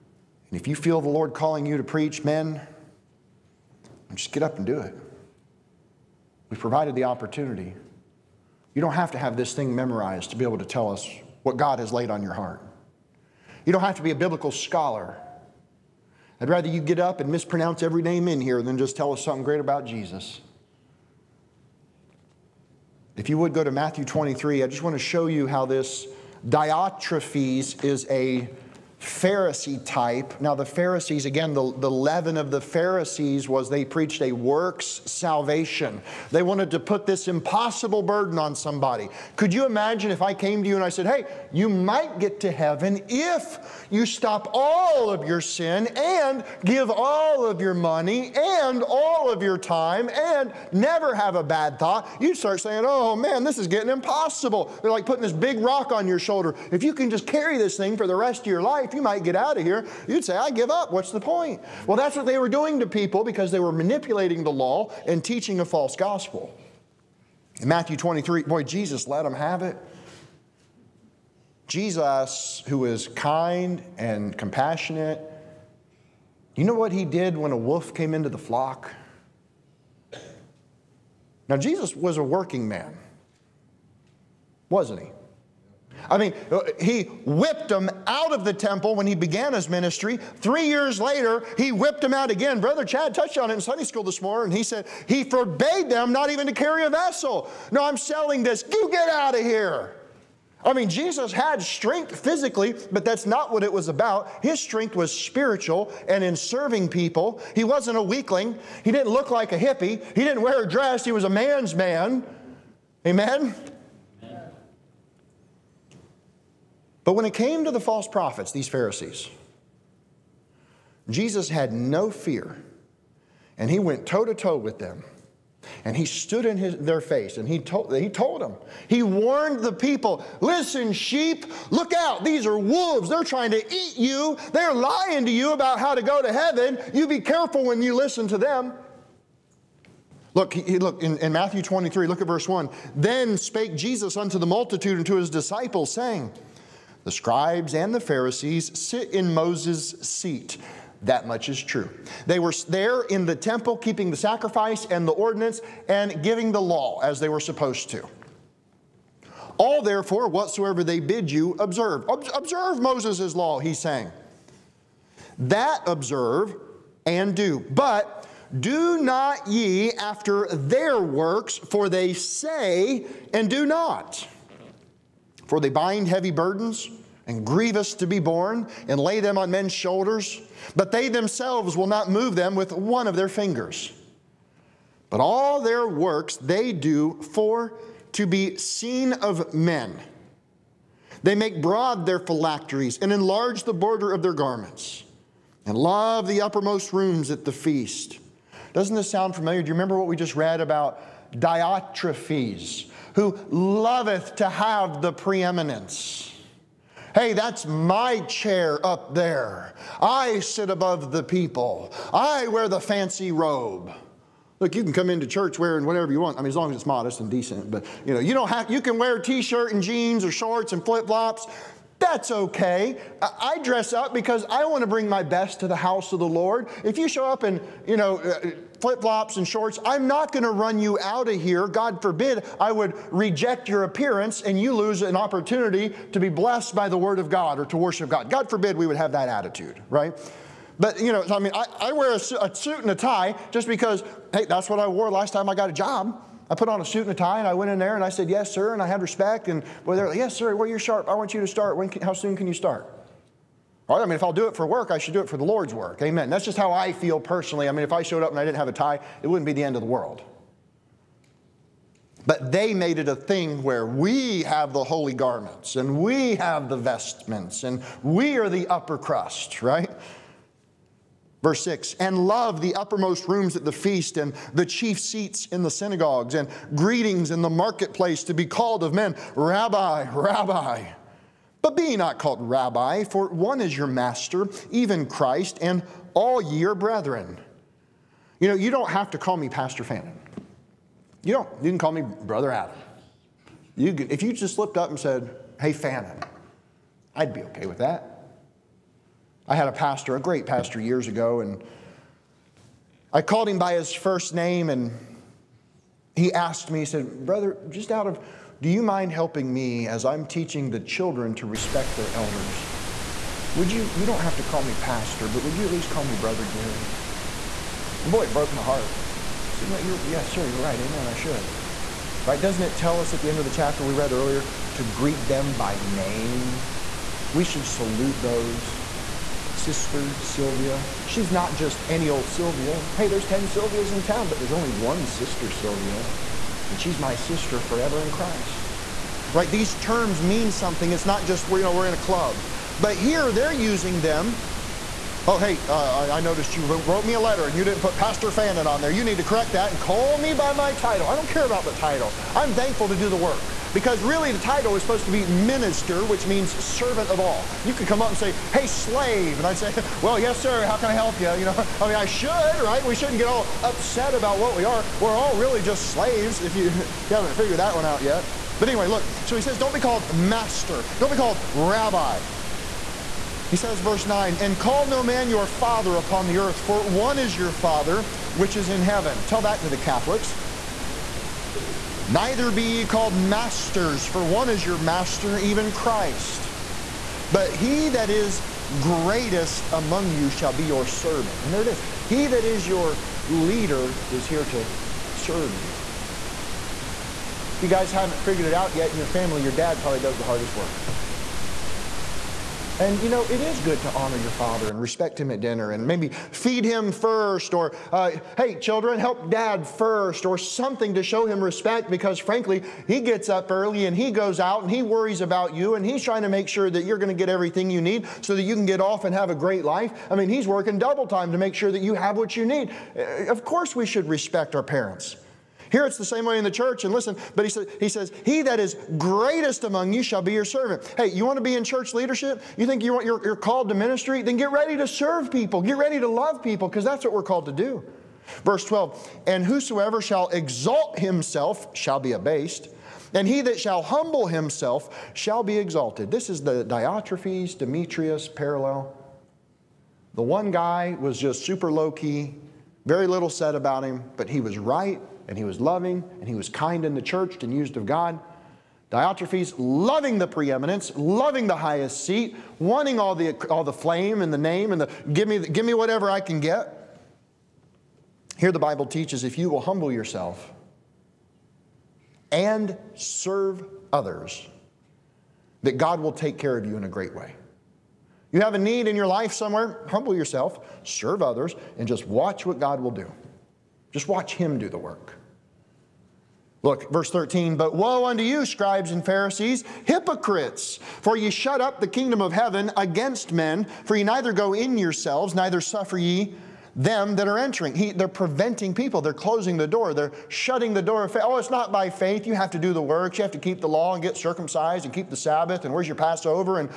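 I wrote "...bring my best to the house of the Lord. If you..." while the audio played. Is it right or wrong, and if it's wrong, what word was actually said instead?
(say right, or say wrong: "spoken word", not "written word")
right.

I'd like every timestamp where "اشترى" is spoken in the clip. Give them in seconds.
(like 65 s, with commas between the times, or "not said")
not said.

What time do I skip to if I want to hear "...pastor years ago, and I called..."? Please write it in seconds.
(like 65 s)
300 s.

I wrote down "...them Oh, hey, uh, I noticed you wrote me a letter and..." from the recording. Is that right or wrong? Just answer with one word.
right.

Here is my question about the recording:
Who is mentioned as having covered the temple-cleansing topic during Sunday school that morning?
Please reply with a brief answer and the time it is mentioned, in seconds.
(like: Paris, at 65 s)
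Brother Chad, at 92 s.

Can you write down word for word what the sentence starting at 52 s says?
You start saying, oh man, this is getting impossible.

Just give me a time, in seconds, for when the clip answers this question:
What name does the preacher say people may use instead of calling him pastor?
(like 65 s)
292 s.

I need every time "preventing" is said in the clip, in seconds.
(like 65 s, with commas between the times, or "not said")
498 s.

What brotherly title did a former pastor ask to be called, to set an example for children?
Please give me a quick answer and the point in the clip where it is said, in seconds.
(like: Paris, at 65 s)
Brother Gary, at 316 s.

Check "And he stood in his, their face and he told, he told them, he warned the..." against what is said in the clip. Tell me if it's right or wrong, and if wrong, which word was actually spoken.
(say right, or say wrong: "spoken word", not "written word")
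right.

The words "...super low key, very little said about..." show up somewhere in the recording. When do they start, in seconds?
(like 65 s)
451 s.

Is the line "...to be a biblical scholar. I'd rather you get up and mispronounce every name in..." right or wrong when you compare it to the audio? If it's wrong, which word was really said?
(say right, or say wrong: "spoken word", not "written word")
right.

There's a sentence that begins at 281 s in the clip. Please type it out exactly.
But be not called Rabbi, for one is your master, even Christ, and all ye are brethren.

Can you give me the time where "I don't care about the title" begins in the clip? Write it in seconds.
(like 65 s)
351 s.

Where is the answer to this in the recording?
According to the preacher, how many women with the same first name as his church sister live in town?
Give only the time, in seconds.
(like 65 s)
333 s.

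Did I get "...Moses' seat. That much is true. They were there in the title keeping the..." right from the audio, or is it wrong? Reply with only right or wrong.
wrong.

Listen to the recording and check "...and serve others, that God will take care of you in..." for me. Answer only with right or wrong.
right.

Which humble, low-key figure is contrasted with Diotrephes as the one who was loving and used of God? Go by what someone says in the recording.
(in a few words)
Demetrius.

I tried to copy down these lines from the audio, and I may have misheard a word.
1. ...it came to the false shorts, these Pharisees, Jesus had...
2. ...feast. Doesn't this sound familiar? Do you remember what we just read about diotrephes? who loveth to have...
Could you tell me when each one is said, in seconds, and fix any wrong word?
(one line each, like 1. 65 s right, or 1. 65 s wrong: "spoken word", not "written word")
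1. 117 s wrong: "prophets", not "shorts"
2. 197 s right.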